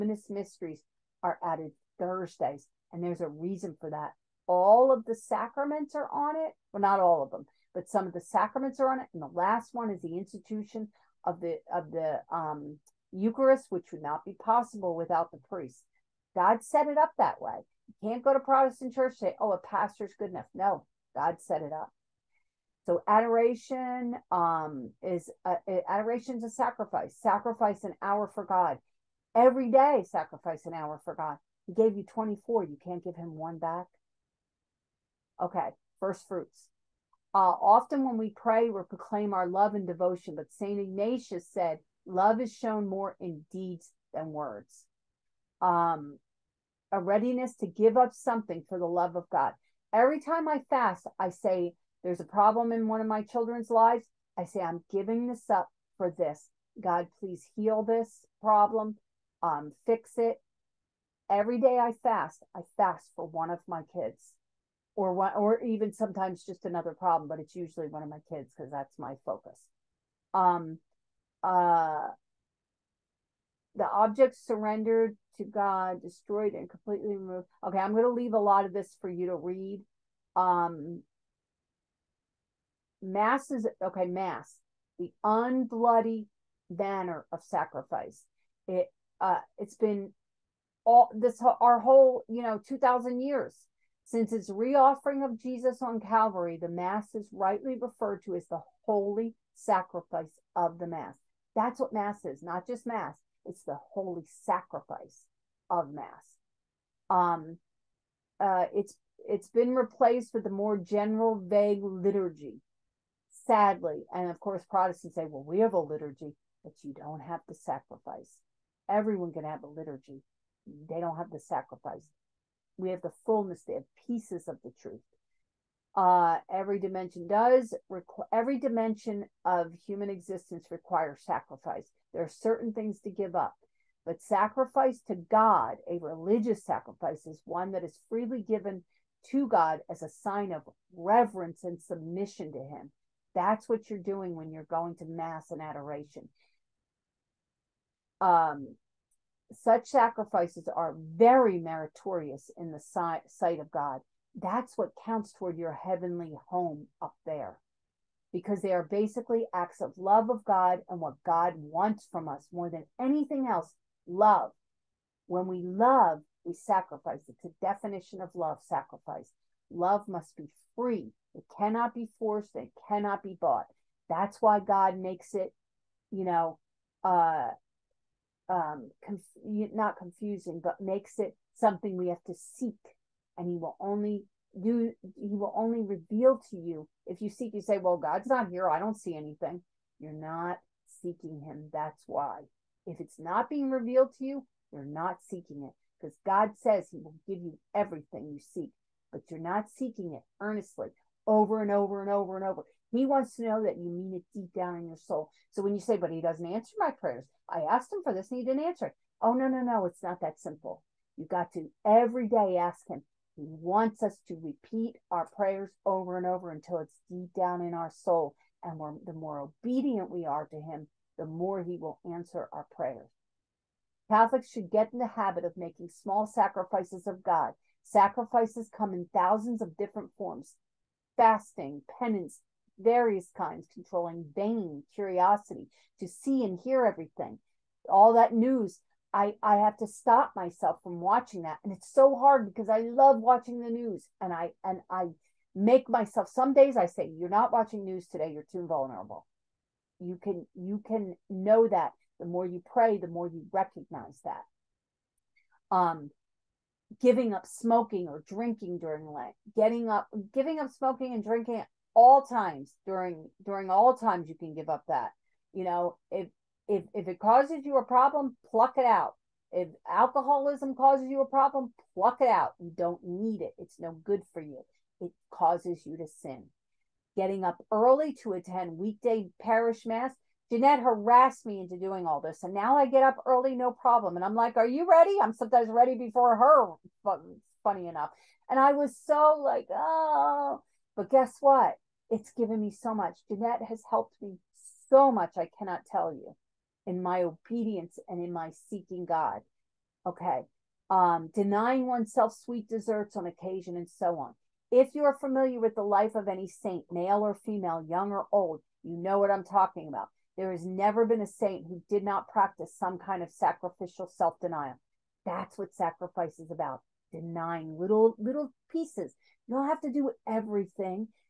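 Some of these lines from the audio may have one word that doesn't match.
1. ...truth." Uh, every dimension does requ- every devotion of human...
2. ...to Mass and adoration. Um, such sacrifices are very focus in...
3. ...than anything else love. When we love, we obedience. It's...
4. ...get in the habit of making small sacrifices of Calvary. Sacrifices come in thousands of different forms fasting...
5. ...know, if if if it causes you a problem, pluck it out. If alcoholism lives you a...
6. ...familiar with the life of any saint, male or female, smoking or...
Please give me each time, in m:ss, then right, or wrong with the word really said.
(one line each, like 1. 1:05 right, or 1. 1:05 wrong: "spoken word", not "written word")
1. 2:04 wrong: "dimension", not "devotion"
2. 2:24 wrong: "meritorious", not "focus"
3. 2:42 wrong: "sacrifice", not "obedience"
4. 3:44 wrong: "God", not "Calvary"
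5. 4:25 wrong: "causes", not "lives"
6. 5:05 wrong: "young", not "smoking".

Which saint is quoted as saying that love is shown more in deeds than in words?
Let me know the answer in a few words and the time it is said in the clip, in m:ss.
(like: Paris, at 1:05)
Saint Ignatius, at 0:40.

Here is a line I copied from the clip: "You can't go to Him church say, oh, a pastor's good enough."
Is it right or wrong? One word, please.
wrong.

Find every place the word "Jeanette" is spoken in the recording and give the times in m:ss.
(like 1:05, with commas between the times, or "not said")
4:40, 4:53.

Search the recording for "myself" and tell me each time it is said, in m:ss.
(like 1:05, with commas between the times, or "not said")
4:00, 4:05.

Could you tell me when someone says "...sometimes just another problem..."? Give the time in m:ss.
1:05.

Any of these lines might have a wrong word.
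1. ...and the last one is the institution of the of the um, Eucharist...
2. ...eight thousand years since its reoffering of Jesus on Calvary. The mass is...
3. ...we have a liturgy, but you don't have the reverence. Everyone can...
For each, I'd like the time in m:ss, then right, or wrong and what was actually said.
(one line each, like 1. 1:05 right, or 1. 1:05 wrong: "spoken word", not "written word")
1. 0:09 right
2. 1:32 wrong: "two", not "eight"
3. 1:55 wrong: "sacrifice", not "reverence".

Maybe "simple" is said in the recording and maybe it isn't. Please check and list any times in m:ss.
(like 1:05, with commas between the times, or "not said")
3:30.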